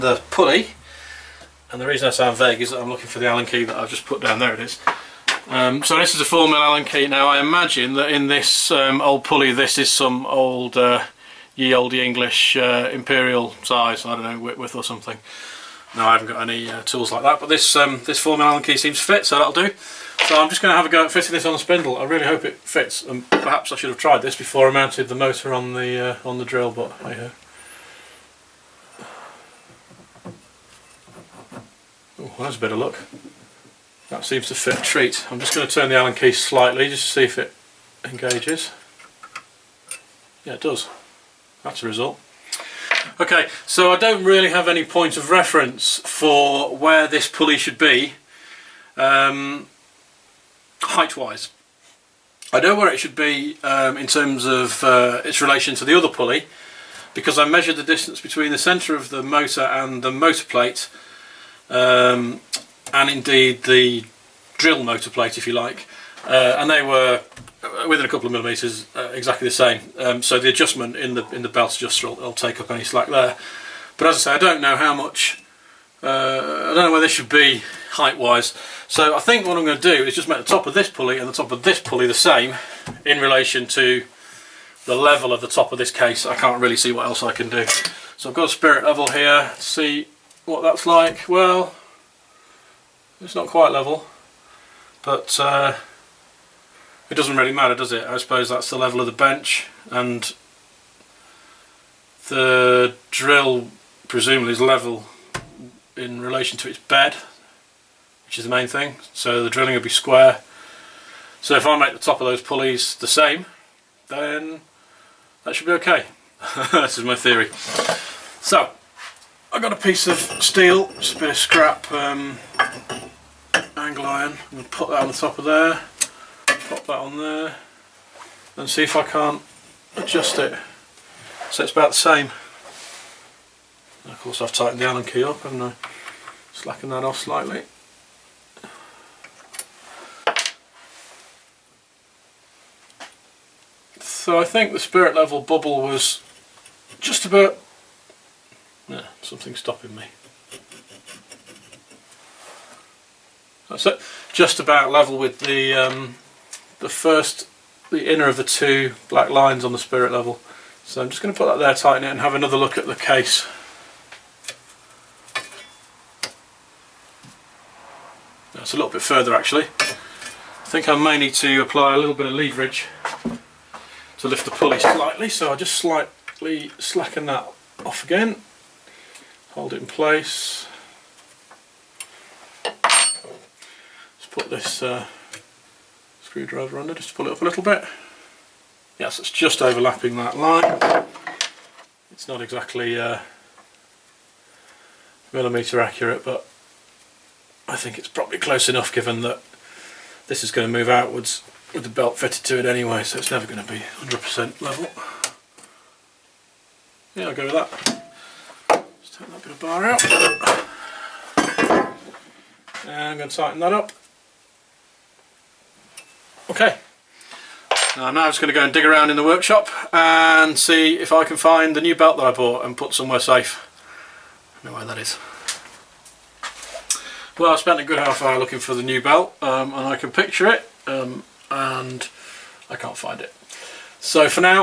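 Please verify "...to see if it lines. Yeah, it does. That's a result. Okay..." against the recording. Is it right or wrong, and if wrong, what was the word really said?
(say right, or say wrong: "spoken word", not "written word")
wrong: "engages", not "lines".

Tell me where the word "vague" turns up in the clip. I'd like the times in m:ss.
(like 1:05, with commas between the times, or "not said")
0:02.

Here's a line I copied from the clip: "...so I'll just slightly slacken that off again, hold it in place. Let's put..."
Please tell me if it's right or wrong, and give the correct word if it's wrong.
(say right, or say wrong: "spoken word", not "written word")
right.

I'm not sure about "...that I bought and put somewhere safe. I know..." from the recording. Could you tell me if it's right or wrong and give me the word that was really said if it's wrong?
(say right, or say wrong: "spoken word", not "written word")
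right.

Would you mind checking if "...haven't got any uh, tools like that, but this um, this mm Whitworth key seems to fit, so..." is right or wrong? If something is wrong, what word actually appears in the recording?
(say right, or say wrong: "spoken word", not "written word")
wrong: "Allen", not "Whitworth".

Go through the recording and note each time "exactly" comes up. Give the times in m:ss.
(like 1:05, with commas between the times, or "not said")
1:09, 3:12.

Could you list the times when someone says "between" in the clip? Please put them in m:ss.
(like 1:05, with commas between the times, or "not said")
0:58.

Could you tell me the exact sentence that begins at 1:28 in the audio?
So I've got a spirit level here.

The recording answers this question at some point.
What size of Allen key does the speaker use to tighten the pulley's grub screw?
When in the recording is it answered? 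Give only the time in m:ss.
0:06.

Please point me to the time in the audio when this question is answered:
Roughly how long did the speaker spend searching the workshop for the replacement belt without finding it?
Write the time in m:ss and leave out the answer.
3:47.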